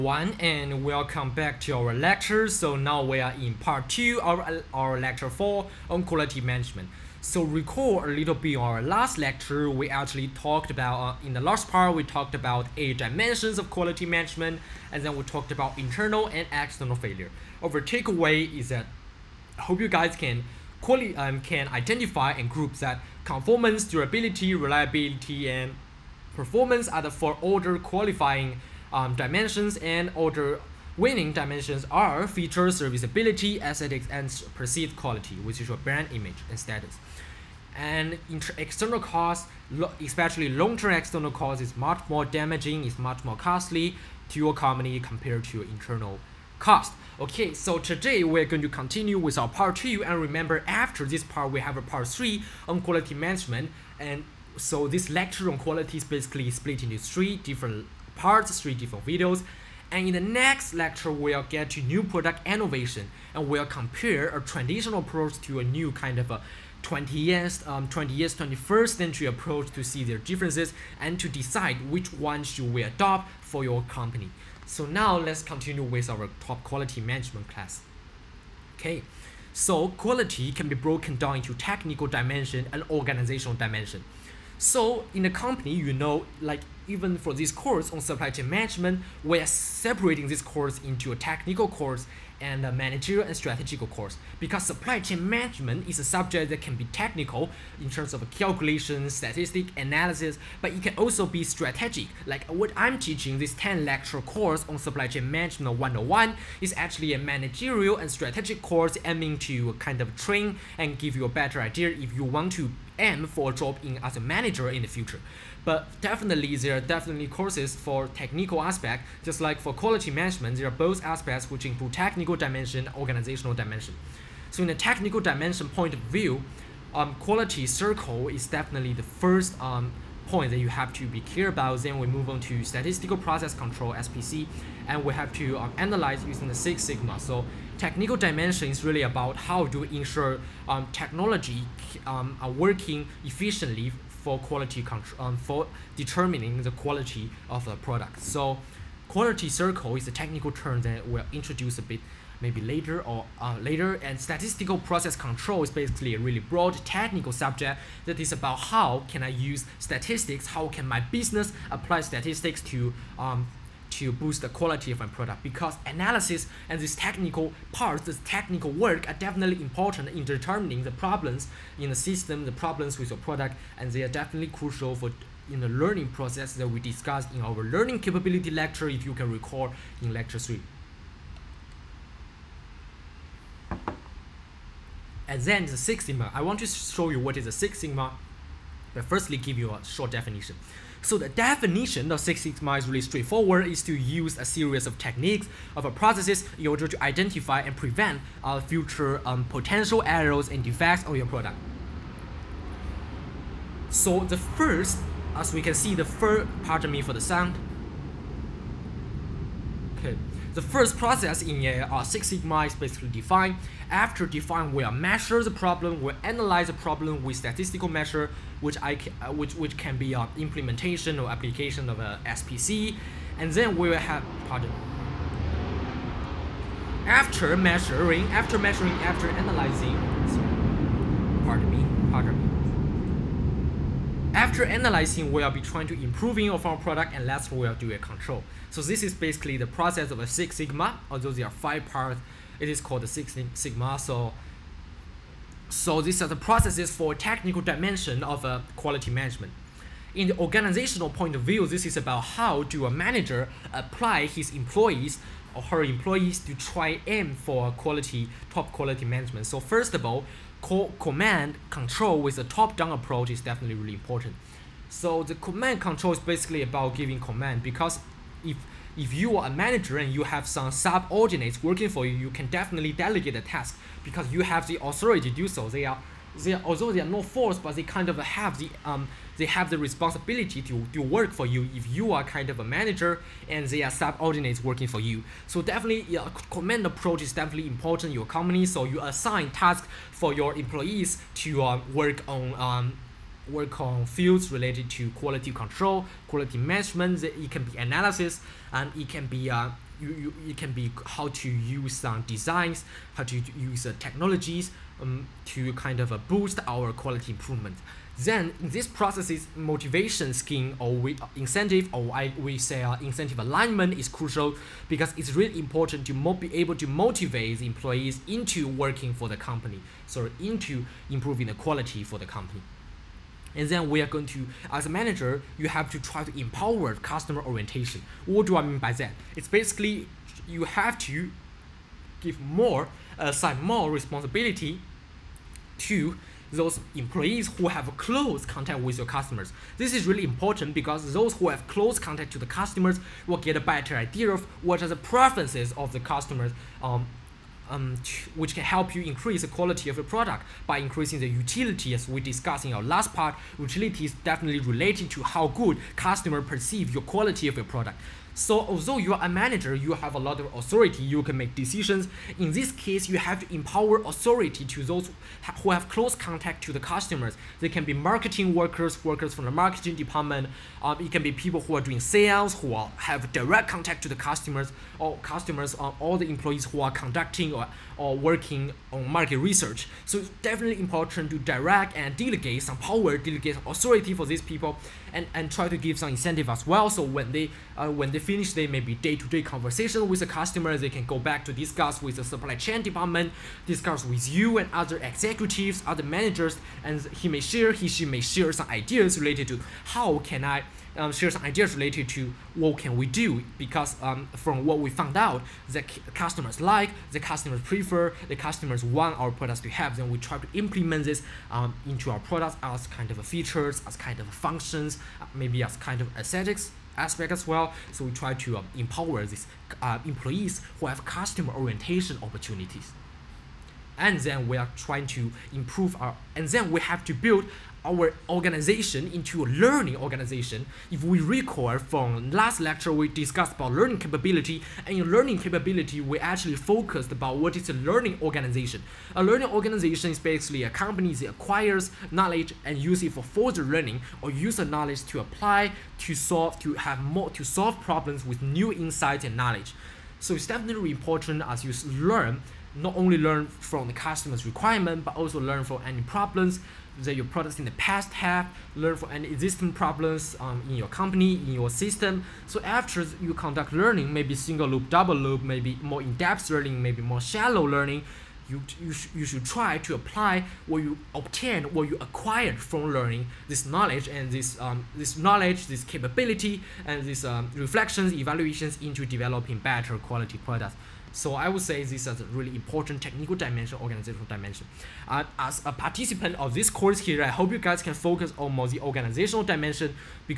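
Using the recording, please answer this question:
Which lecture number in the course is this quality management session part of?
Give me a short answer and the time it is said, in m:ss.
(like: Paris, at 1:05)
4, at 0:04.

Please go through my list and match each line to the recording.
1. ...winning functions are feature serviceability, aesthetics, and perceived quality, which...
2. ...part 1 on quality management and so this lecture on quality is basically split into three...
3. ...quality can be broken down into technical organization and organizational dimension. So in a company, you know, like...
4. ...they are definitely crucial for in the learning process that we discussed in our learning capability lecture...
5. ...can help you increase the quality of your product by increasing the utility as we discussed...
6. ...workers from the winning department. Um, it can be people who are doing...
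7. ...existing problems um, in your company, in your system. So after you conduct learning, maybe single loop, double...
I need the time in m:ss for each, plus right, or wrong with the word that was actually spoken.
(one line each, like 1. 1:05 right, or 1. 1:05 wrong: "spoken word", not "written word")
1. 0:30 wrong: "dimensions", not "functions"
2. 0:51 wrong: "3", not "1"
3. 1:19 wrong: "dimension", not "organization"
4. 2:53 right
5. 5:48 right
6. 6:09 wrong: "marketing", not "winning"
7. 7:39 right.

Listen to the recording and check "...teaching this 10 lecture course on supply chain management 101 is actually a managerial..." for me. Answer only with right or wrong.
right.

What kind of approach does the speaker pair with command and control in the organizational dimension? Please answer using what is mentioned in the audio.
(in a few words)
top-down.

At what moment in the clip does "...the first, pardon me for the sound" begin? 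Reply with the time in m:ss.
3:25.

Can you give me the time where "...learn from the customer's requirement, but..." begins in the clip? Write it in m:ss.
7:33.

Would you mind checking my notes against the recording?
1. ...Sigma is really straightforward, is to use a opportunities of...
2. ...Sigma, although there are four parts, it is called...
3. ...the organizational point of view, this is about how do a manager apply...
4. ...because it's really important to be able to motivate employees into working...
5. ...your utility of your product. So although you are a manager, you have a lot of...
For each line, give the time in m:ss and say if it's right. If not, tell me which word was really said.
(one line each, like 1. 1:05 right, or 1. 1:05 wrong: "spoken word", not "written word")
1. 3:12 wrong: "series", not "opportunities"
2. 4:00 wrong: "five", not "four"
3. 4:10 right
4. 5:14 right
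5. 5:56 wrong: "quality", not "utility".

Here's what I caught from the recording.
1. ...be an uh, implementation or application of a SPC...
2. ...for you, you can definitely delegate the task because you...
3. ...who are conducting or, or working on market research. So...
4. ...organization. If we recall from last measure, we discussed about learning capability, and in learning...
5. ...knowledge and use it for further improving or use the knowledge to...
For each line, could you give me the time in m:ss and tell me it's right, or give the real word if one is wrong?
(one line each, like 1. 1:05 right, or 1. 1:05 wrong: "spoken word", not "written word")
1. 3:39 right
2. 4:31 right
3. 6:16 right
4. 7:09 wrong: "lecture", not "measure"
5. 7:22 wrong: "learning", not "improving".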